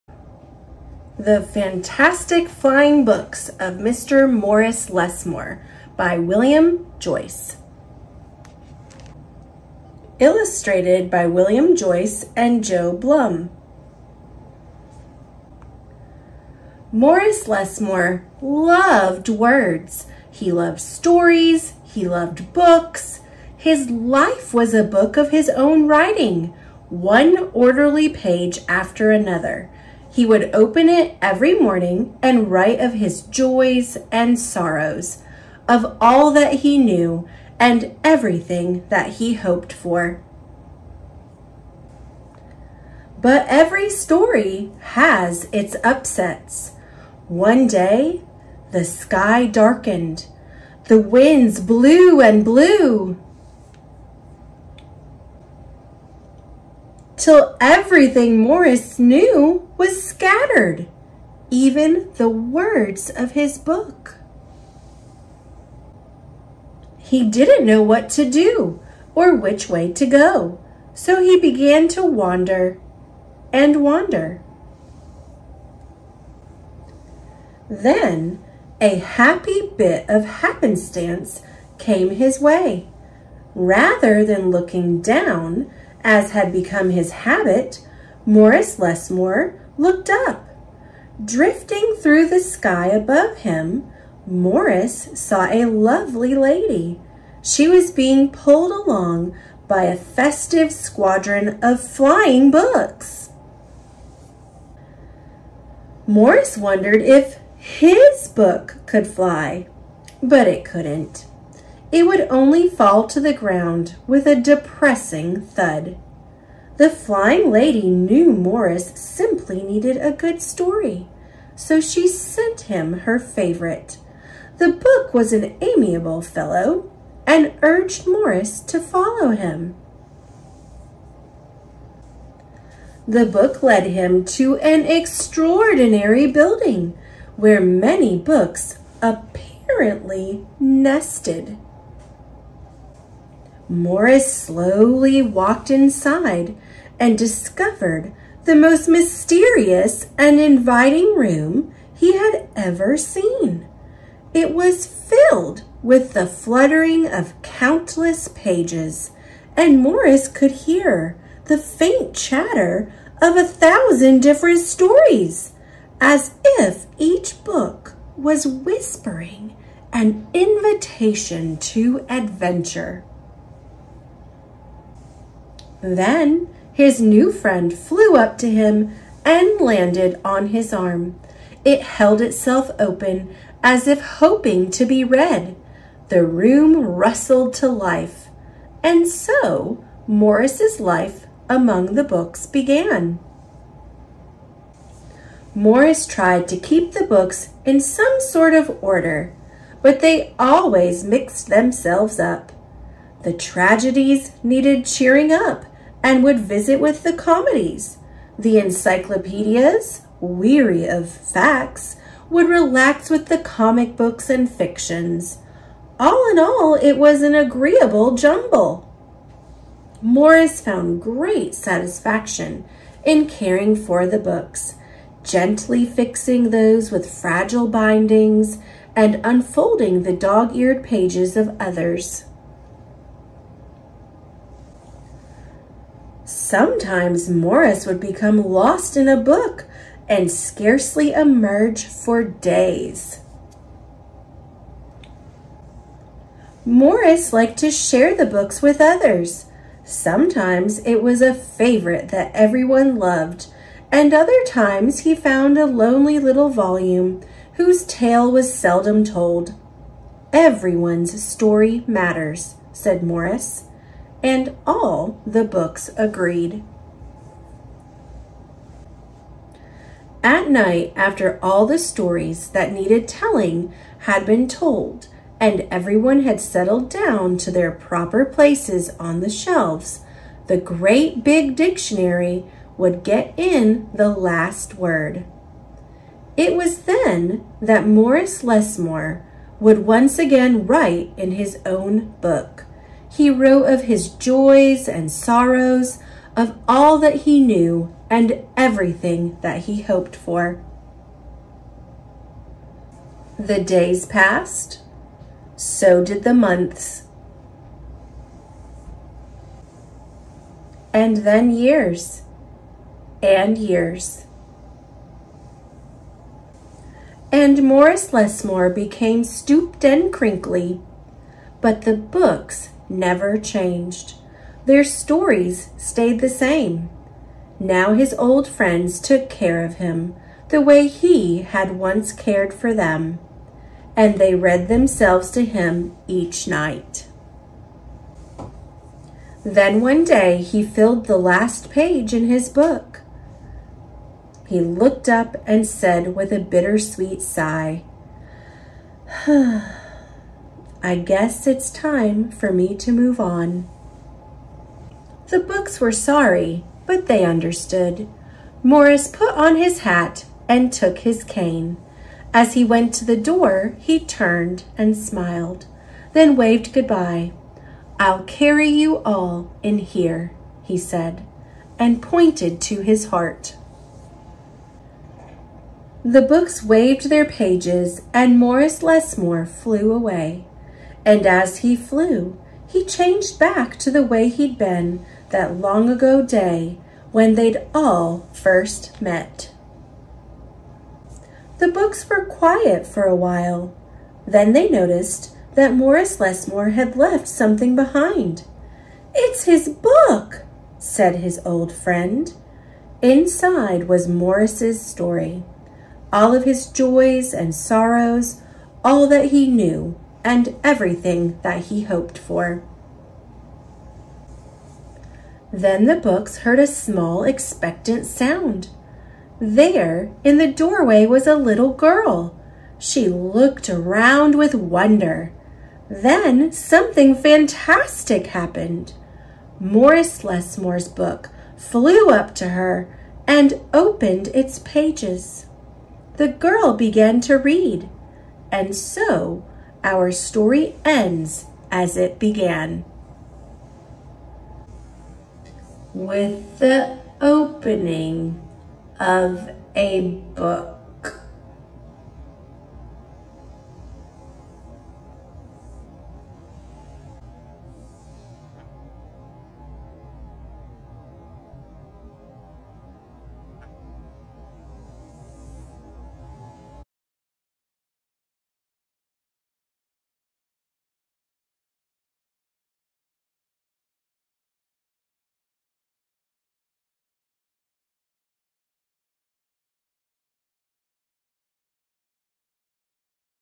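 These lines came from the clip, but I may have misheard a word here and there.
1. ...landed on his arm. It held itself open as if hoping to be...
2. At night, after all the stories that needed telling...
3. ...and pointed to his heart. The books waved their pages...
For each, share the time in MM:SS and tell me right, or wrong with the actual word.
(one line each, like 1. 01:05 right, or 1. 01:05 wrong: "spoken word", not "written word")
1. 02:59 right
2. 04:30 right
3. 06:11 right.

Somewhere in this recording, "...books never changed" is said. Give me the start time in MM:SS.
05:21.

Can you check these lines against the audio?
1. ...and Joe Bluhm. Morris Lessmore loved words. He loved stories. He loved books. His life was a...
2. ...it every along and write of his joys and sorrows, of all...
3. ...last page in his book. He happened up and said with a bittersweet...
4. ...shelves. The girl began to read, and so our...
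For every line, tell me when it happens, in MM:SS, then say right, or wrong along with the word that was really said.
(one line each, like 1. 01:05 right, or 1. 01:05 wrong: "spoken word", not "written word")
1. 00:12 right
2. 00:30 wrong: "morning", not "along"
3. 05:41 wrong: "looked", not "happened"
4. 07:14 wrong: "pages", not "shelves".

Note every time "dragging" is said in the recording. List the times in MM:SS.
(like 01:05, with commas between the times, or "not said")
not said.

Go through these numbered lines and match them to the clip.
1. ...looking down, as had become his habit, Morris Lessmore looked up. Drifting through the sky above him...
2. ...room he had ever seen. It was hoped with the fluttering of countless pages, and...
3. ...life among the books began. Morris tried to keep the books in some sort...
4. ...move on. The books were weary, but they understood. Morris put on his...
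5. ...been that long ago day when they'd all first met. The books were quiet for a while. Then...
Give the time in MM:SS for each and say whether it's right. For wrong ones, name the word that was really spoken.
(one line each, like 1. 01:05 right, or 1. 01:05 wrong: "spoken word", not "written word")
1. 01:24 right
2. 02:31 wrong: "filled", not "hoped"
3. 03:10 right
4. 05:52 wrong: "sorry", not "weary"
5. 06:24 right.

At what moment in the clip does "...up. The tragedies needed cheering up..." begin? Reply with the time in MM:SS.
03:22.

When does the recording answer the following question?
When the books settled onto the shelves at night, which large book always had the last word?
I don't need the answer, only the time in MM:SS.
04:40.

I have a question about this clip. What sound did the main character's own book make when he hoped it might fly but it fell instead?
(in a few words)
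a depressing thud.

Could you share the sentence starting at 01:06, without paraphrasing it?
He didn't know what to do or which way to go, so he began to wander and wander.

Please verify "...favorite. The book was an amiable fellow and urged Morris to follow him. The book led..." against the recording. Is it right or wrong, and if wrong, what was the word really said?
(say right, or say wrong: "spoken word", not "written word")
right.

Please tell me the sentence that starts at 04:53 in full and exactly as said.
He wrote of his joys and sorrows, of all that he knew and everything that he hoped for.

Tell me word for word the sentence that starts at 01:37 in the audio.
She was being pulled along by a festive squadron of flying books.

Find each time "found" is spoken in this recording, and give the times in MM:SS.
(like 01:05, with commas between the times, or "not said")
03:40, 04:15.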